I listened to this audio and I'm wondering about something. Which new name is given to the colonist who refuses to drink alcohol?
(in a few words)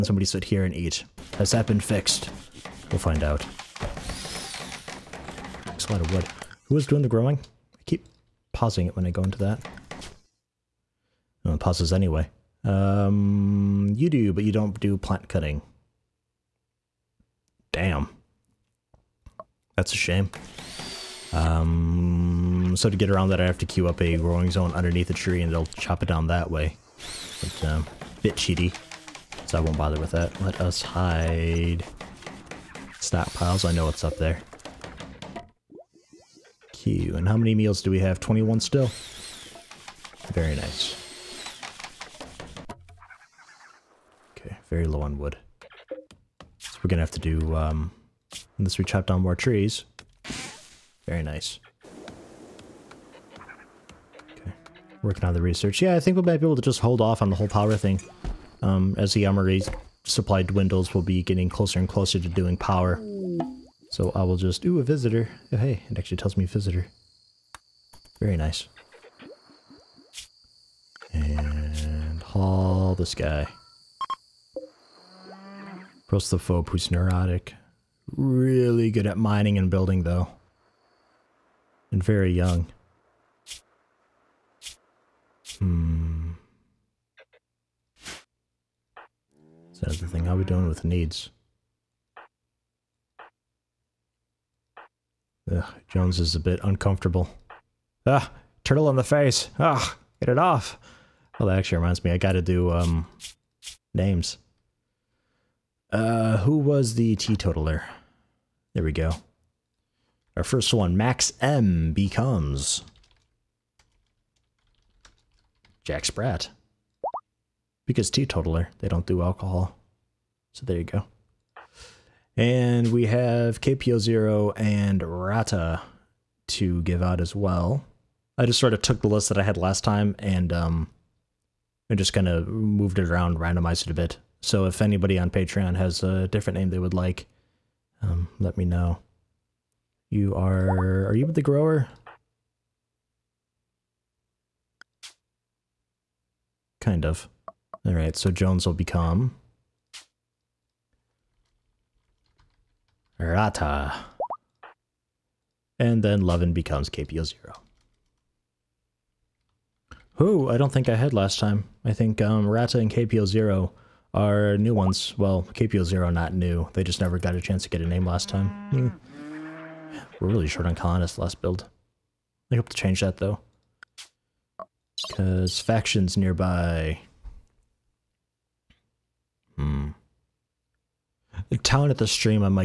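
Jack Sprat.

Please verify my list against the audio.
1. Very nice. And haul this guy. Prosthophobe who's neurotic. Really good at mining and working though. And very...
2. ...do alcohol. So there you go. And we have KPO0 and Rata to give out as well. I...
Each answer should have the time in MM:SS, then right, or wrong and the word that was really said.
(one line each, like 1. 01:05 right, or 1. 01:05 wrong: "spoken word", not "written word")
1. 01:08 wrong: "building", not "working"
2. 01:59 right.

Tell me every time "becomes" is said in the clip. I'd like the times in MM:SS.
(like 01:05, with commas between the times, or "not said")
01:51, 02:28, 02:36.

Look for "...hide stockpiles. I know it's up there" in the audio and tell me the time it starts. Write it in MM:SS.
00:30.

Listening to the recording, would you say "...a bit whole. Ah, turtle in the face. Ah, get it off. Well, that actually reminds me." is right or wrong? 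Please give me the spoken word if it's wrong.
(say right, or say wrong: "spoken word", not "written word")
wrong: "uncomfortable", not "whole".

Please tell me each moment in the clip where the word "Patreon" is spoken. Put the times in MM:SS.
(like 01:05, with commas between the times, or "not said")
02:15.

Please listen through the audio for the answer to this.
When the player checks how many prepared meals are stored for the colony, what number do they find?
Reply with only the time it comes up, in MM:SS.
00:38.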